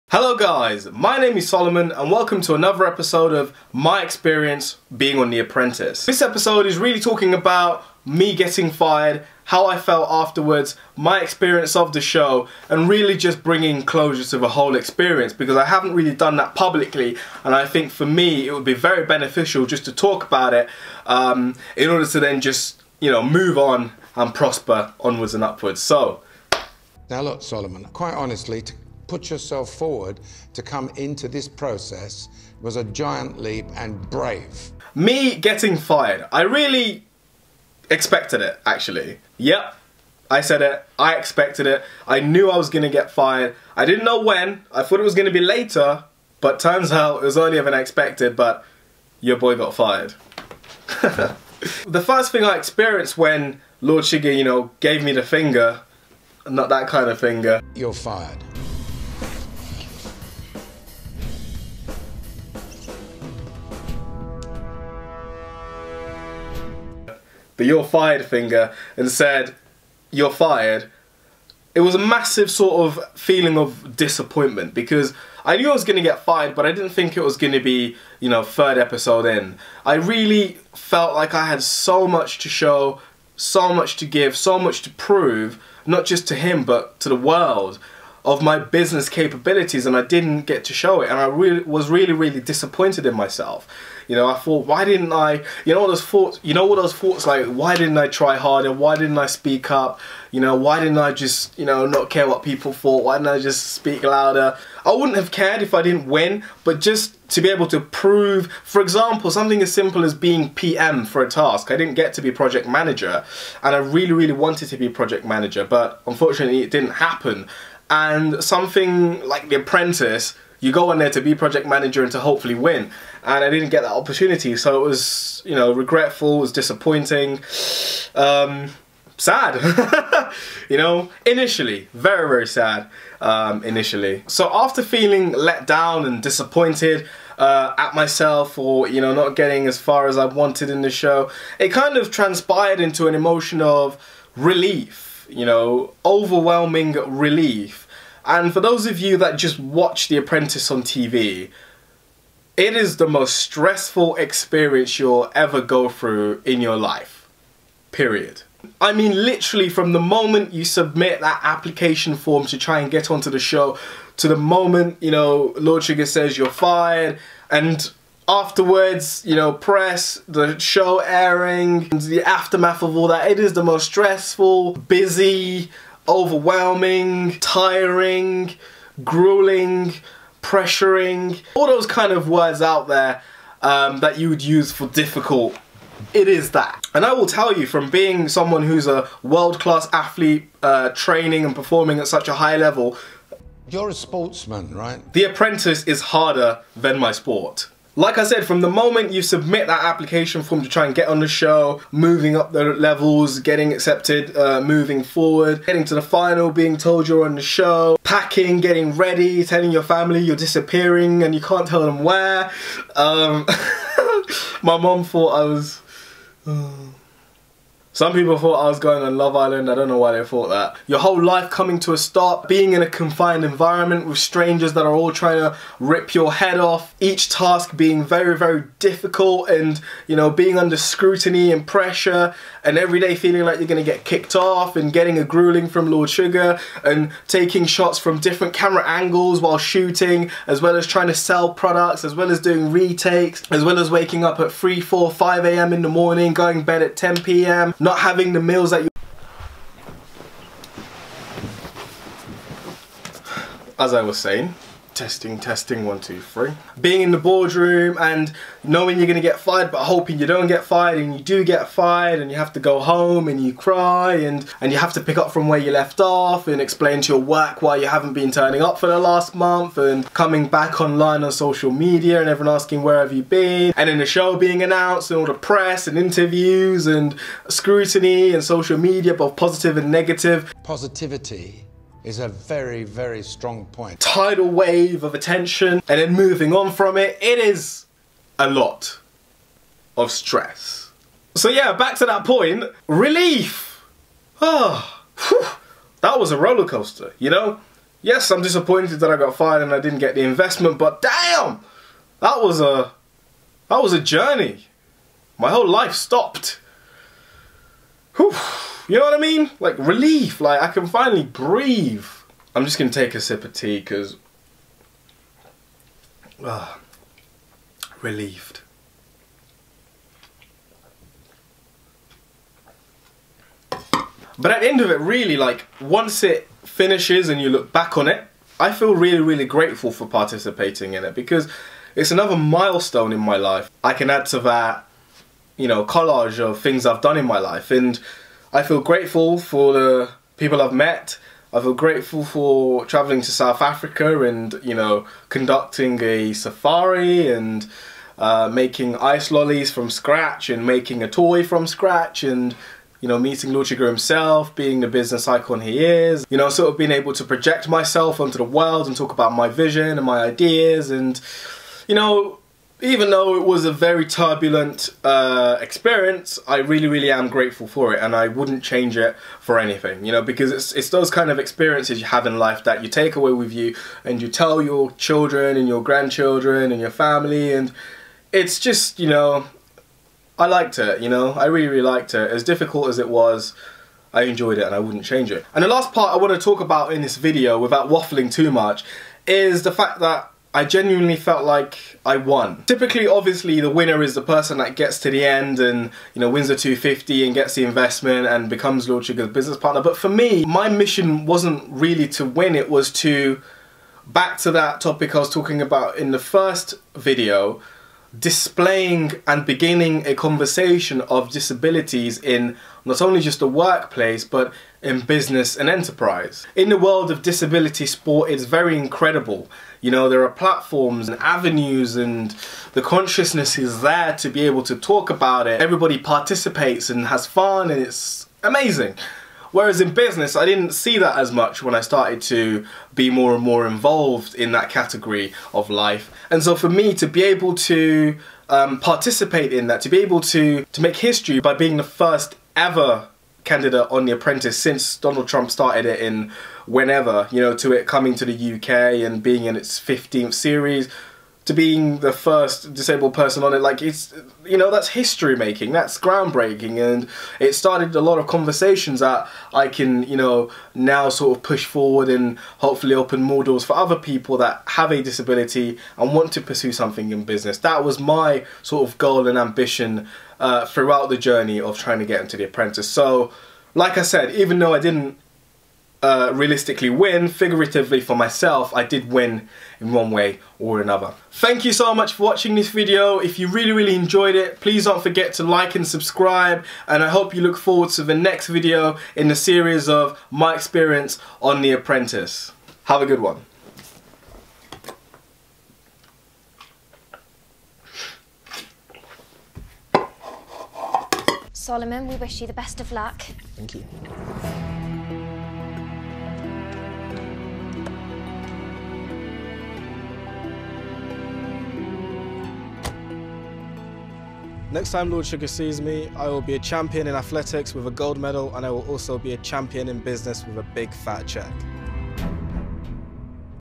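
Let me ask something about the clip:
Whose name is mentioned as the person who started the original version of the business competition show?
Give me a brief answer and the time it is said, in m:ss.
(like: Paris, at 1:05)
Donald Trump, at 7:24.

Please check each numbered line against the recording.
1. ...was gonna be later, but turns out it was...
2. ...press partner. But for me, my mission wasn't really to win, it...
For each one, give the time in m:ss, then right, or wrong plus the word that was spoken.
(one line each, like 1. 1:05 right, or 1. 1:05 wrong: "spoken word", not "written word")
1. 0:45 right
2. 6:39 wrong: "business", not "press".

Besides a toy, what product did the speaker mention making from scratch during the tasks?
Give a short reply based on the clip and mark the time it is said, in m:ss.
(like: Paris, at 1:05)
ice lollies, at 5:48.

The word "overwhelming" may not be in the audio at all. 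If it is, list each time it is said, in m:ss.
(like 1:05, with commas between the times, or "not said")
2:26, 2:56.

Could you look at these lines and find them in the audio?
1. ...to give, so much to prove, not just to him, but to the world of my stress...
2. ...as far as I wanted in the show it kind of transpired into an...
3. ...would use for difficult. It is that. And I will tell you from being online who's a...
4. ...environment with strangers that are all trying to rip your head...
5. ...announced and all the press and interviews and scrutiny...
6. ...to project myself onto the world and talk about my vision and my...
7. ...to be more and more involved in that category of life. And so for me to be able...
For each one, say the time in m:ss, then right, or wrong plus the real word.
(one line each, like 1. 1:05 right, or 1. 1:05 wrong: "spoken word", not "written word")
1. 1:23 wrong: "business", not "stress"
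2. 2:19 right
3. 3:04 wrong: "someone", not "online"
4. 3:43 right
5. 4:34 right
6. 5:57 right
7. 7:12 right.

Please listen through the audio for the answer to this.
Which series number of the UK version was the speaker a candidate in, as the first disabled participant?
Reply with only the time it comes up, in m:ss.
7:29.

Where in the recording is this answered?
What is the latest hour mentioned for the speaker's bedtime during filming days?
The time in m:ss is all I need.
4:06.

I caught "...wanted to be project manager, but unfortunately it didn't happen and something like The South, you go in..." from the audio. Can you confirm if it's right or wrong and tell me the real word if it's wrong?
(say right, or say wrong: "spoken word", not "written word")
wrong: "Apprentice", not "South".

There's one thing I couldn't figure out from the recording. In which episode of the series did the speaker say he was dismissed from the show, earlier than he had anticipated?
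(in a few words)
third episode.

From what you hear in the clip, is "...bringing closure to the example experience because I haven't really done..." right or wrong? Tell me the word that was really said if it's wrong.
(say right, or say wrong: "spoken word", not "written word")
wrong: "whole", not "example".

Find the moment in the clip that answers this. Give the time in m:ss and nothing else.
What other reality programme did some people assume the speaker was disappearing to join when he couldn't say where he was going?
3:39.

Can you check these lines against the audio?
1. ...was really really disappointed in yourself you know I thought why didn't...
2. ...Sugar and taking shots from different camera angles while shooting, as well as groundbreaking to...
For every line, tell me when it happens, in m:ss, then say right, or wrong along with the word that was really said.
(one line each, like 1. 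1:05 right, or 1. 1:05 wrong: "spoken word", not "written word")
1. 1:31 wrong: "myself", not "yourself"
2. 3:56 wrong: "trying", not "groundbreaking".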